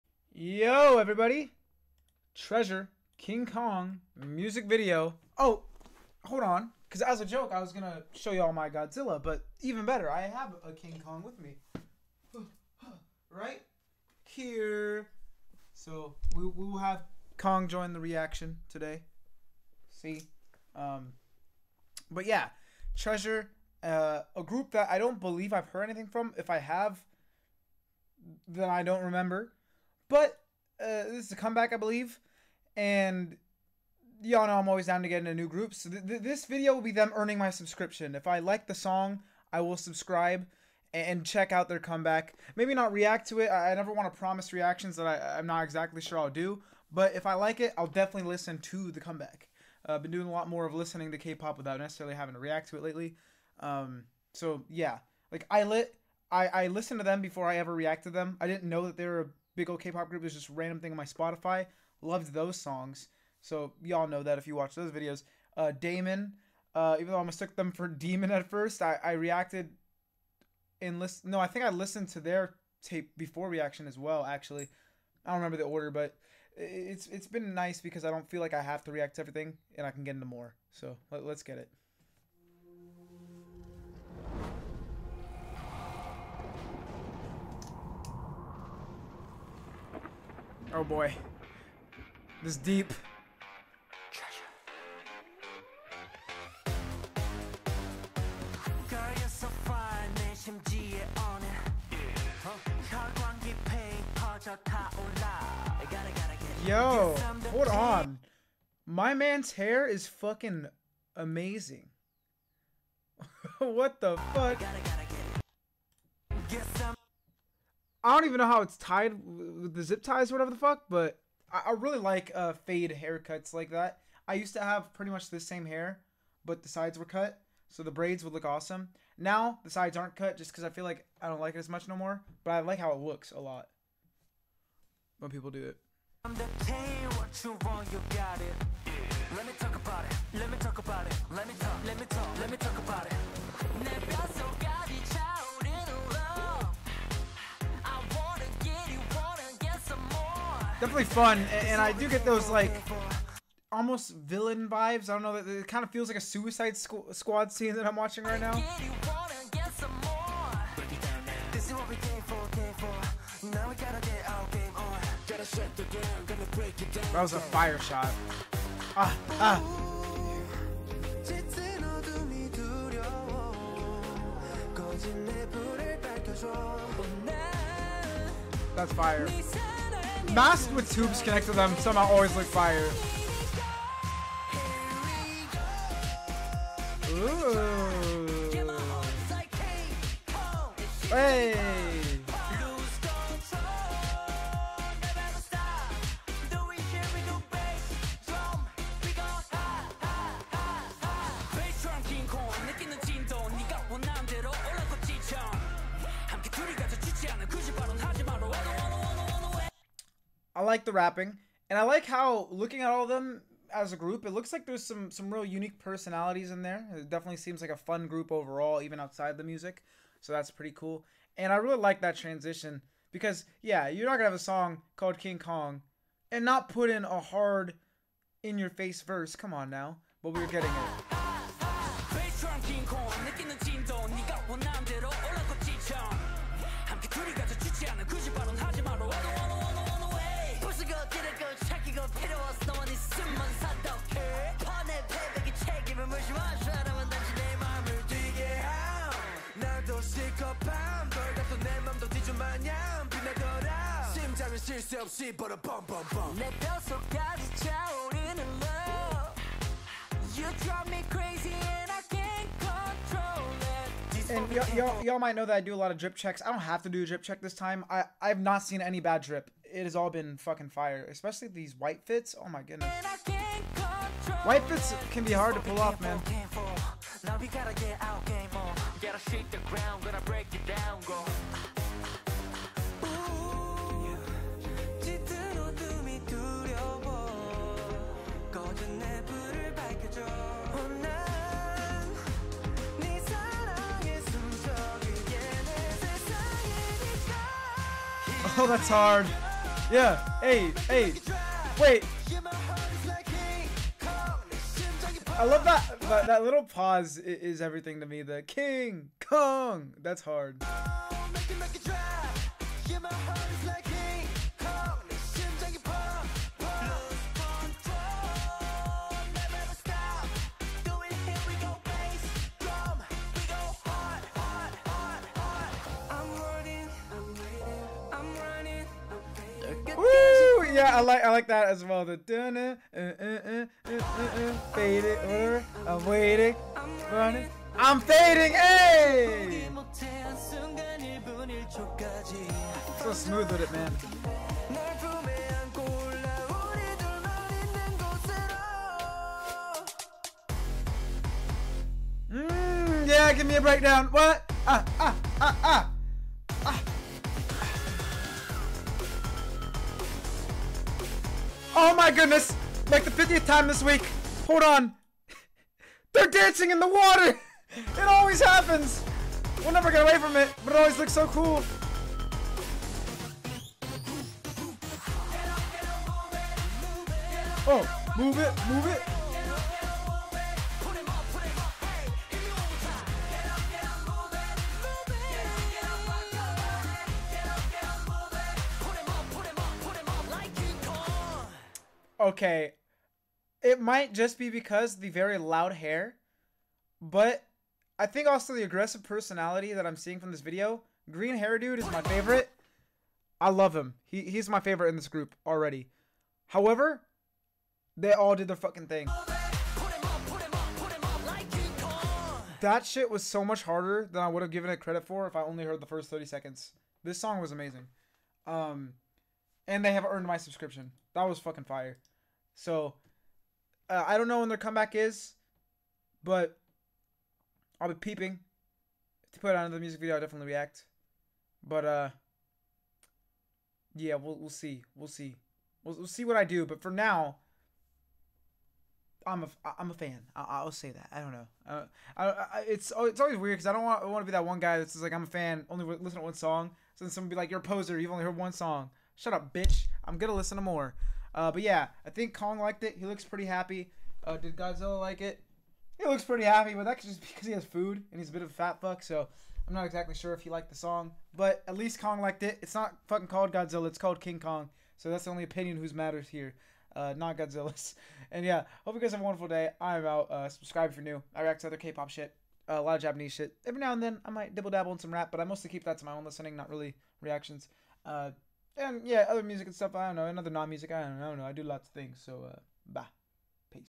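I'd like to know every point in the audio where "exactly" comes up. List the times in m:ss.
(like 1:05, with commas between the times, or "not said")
0:45, 7:39.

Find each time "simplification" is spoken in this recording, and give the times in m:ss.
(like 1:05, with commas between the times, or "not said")
not said.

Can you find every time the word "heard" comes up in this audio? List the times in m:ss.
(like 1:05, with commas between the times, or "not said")
0:25, 6:55, 7:28.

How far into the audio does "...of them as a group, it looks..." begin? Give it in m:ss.
3:33.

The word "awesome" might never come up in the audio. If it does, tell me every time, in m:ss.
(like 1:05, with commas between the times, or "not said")
2:08.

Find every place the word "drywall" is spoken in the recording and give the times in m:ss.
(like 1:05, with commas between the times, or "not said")
not said.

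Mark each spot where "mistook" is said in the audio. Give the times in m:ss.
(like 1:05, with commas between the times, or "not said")
1:07.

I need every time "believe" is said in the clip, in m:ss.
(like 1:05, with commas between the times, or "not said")
0:25, 0:31.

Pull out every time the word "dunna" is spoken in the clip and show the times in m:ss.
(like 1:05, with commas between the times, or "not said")
5:32.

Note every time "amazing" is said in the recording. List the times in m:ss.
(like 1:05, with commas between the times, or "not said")
1:51, 6:57.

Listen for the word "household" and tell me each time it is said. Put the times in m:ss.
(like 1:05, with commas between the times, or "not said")
not said.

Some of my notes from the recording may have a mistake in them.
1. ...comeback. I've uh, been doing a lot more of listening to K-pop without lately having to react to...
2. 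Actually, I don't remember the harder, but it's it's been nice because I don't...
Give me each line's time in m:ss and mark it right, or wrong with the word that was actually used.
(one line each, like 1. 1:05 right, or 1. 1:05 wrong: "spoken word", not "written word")
1. 0:48 wrong: "necessarily", not "lately"
2. 1:14 wrong: "order", not "harder".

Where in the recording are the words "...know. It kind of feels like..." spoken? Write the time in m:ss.
2:35.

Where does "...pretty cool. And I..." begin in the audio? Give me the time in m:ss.
3:40.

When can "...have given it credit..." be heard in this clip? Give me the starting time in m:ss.
6:54.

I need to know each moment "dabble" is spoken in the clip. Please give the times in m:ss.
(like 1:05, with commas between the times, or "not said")
7:54.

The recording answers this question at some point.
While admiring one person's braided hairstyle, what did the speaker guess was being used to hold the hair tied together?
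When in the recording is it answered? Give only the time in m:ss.
1:59.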